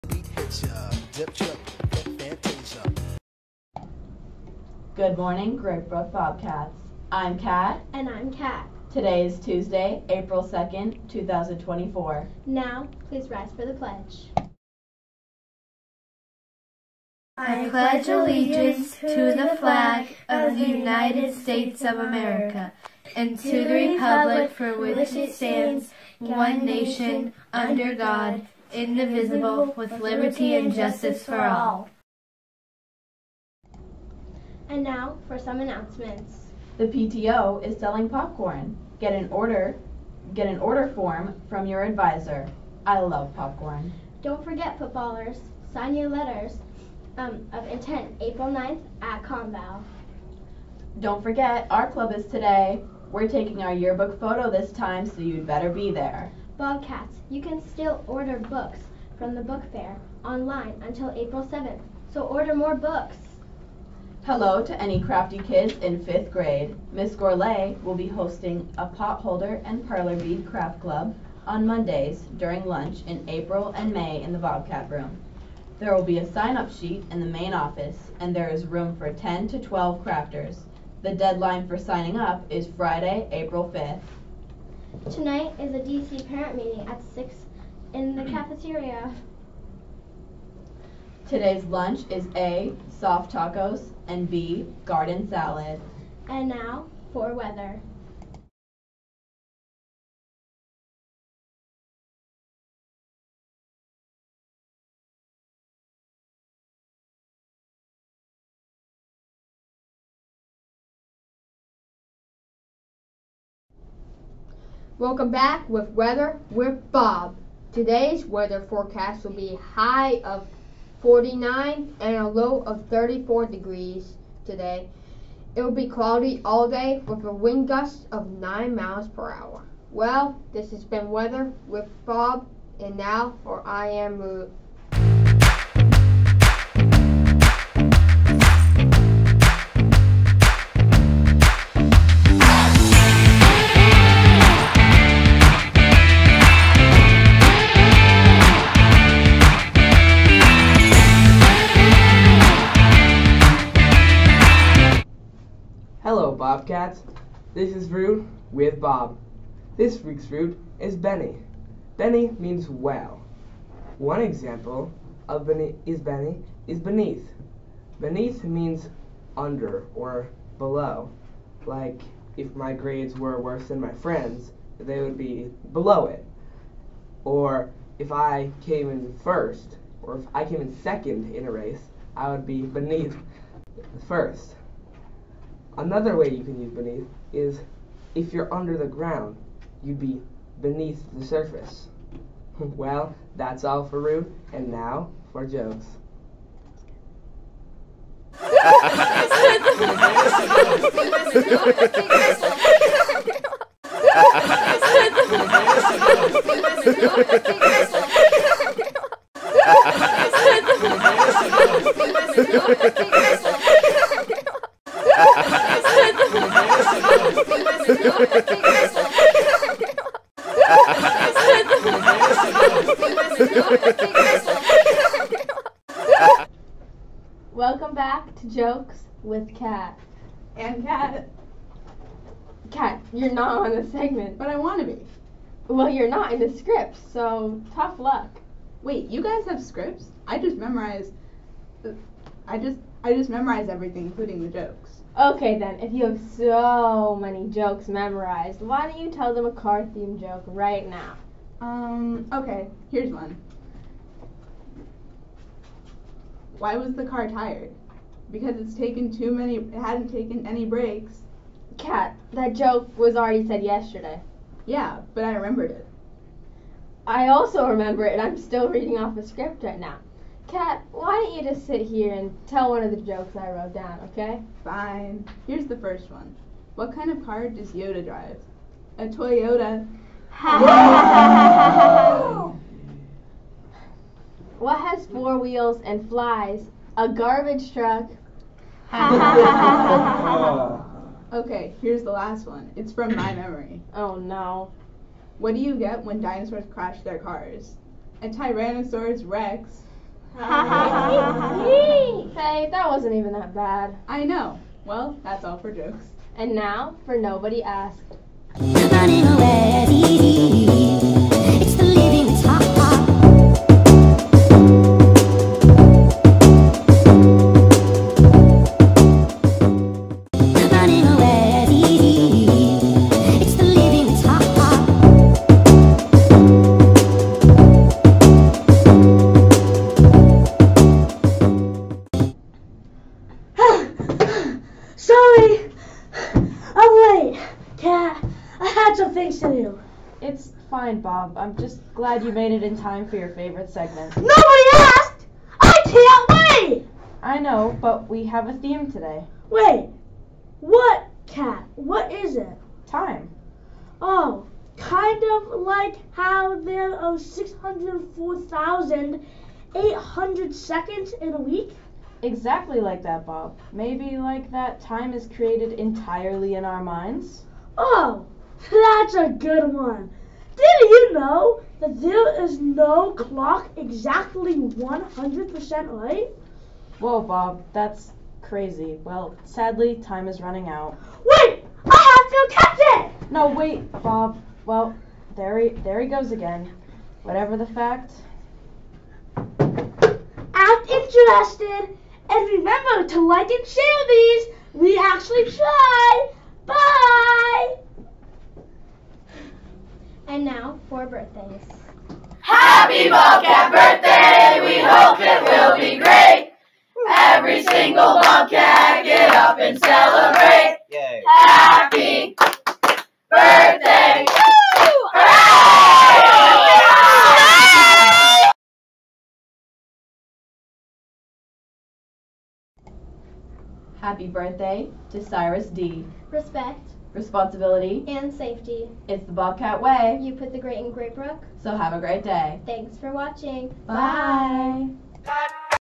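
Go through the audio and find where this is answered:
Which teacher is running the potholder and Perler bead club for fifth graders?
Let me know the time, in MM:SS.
01:06.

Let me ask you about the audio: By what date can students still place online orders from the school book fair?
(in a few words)
April 7th.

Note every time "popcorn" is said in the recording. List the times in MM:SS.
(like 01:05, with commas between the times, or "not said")
00:38, 00:43.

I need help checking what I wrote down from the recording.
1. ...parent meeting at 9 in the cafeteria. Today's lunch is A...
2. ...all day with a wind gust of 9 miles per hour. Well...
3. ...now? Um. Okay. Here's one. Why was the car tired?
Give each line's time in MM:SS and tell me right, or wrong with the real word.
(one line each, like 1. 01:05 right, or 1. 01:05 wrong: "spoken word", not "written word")
1. 01:26 wrong: "6", not "9"
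2. 02:06 right
3. 04:10 right.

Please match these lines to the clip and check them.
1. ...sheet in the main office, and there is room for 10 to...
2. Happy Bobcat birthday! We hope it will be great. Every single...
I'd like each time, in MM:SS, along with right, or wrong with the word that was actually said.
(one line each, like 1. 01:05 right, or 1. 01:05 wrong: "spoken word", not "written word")
1. 01:16 right
2. 06:42 right.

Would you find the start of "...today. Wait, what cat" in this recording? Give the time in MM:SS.
05:48.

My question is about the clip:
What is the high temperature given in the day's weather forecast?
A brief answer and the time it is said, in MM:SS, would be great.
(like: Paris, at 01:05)
49, at 02:01.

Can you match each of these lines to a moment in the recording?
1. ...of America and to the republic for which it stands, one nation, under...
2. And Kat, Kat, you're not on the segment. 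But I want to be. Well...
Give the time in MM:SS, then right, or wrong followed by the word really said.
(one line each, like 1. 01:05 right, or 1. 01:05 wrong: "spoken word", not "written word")
1. 00:21 right
2. 03:50 right.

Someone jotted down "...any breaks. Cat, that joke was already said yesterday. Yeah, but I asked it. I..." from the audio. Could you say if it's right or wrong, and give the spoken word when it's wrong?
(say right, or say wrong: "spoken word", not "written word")
wrong: "remembered", not "asked".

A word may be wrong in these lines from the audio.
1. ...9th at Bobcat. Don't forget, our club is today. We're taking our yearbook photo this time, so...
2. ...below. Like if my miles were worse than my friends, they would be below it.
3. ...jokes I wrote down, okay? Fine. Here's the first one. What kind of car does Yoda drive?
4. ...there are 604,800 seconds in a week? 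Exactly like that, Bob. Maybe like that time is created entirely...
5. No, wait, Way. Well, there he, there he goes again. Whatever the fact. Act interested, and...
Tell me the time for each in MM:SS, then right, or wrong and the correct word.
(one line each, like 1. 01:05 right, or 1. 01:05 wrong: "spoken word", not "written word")
1. 00:48 wrong: "Conval", not "Bobcat"
2. 02:50 wrong: "grades", not "miles"
3. 04:32 right
4. 05:56 right
5. 06:23 wrong: "Bob", not "Way".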